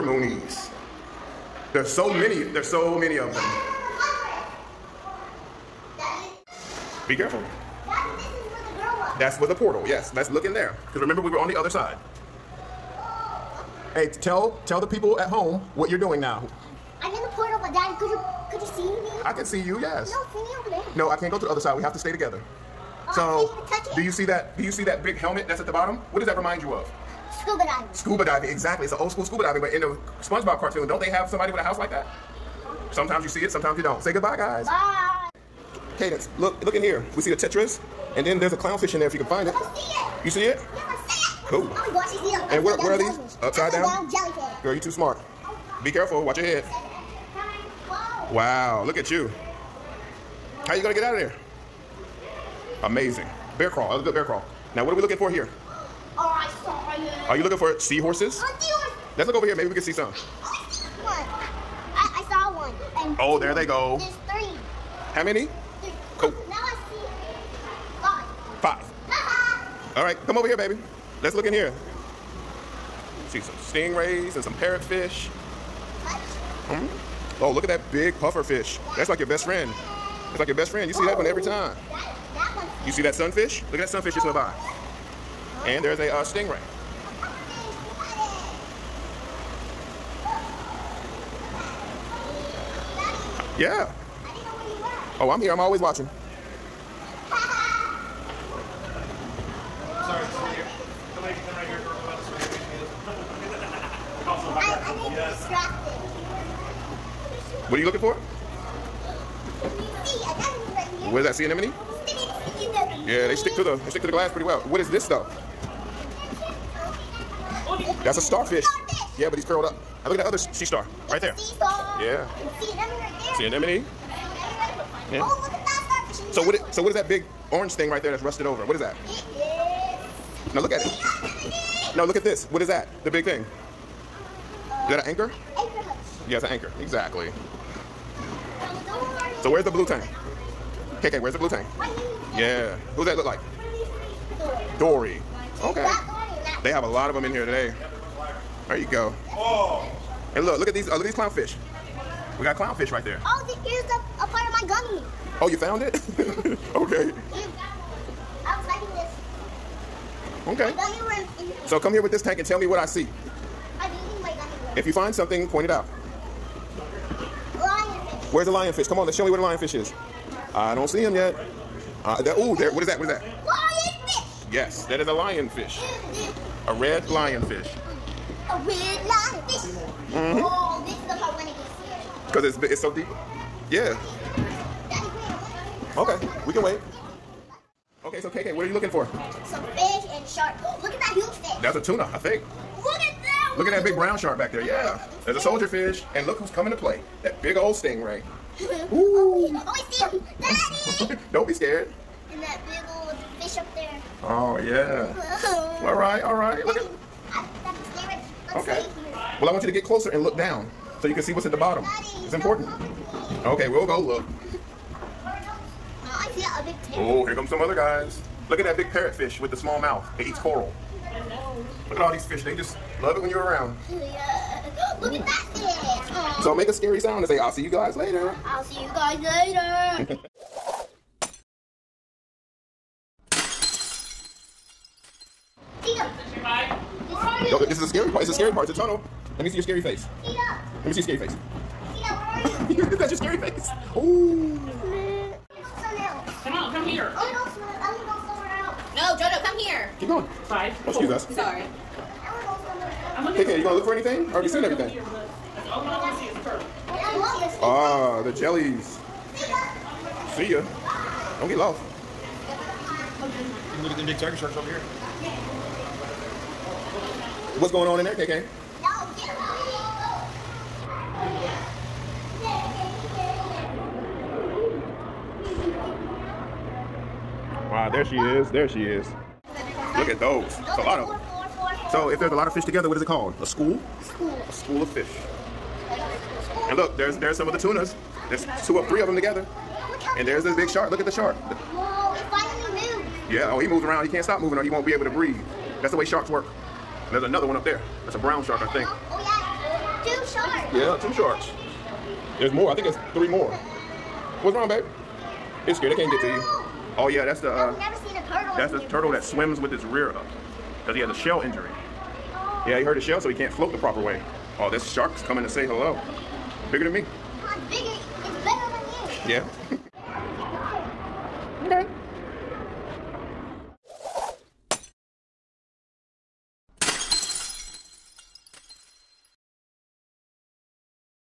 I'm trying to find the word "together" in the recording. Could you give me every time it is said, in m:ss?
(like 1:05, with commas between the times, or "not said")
0:22, 4:42, 4:49.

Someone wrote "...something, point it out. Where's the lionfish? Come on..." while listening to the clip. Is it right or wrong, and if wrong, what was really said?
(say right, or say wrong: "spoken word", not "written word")
right.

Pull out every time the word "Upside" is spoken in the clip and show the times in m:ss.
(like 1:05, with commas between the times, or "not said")
0:43.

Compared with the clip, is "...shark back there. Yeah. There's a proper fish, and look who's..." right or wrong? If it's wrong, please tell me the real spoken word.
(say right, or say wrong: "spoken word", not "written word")
wrong: "soldier", not "proper".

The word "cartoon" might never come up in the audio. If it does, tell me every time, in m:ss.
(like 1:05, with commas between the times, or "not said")
0:30.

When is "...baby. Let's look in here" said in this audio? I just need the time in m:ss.
1:10.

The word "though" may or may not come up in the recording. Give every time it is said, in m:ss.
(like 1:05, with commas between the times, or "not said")
1:55.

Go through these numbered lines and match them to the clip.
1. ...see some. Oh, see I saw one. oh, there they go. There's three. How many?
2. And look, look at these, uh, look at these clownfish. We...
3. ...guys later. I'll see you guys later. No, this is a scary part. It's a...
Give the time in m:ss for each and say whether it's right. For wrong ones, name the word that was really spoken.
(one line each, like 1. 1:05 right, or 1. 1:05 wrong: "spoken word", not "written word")
1. 0:59 right
2. 2:30 right
3. 3:47 right.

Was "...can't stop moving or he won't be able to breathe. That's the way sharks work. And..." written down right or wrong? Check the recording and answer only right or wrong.
right.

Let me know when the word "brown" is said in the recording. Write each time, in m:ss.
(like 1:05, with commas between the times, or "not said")
3:13, 4:58.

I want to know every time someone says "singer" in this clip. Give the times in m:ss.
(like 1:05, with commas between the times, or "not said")
not said.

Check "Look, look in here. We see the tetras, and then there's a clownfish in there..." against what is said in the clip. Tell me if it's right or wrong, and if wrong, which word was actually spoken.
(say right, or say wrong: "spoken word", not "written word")
right.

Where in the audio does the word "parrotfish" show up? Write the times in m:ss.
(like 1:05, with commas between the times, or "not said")
1:14, 3:38.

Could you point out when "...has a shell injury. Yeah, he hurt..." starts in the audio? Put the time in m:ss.
5:10.